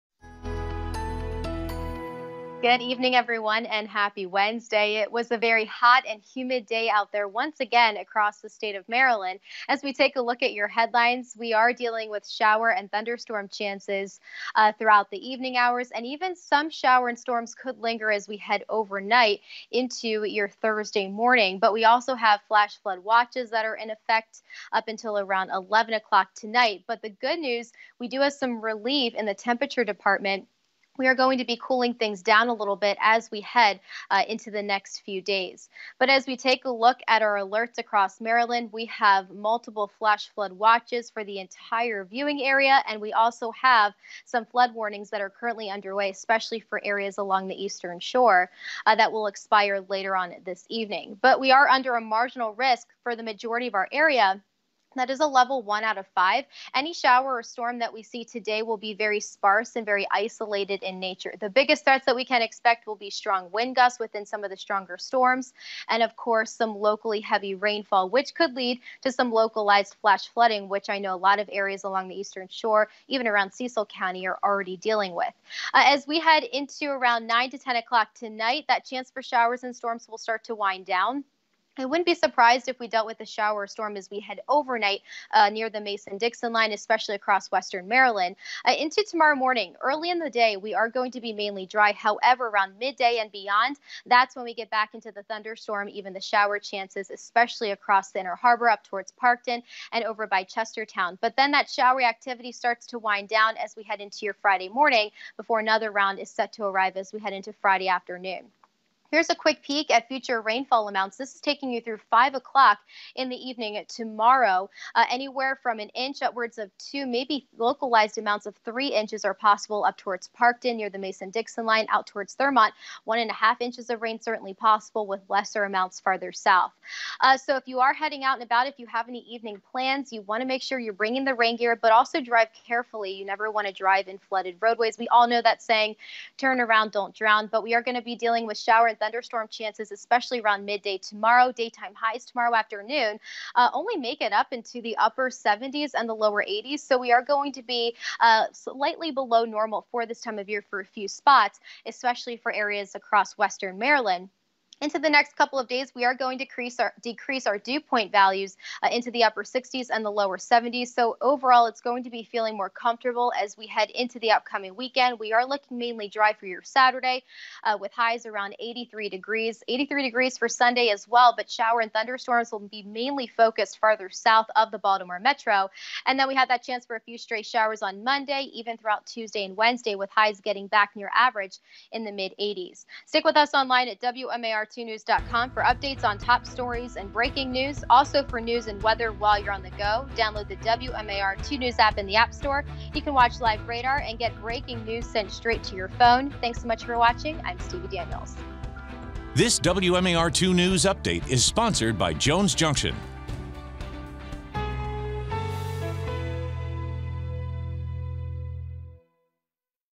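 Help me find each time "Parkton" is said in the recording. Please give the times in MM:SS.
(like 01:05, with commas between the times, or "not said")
01:39, 02:00.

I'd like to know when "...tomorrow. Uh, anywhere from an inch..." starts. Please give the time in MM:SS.
01:53.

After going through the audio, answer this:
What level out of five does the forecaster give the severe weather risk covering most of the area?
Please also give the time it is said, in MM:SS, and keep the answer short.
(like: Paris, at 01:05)
1, at 00:55.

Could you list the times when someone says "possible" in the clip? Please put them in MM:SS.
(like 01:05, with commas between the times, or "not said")
01:59, 02:04.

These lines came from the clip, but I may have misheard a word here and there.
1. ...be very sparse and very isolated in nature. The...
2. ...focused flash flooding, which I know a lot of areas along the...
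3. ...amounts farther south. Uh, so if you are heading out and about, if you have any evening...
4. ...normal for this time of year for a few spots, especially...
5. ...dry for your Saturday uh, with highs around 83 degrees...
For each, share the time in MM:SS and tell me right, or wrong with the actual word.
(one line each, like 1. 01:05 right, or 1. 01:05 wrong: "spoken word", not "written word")
1. 00:58 right
2. 01:09 wrong: "localized", not "focused"
3. 02:05 right
4. 02:29 right
5. 02:46 right.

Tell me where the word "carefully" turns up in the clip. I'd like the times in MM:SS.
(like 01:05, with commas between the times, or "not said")
02:12.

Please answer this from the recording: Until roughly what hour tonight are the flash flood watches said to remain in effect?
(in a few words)
11 o'clock.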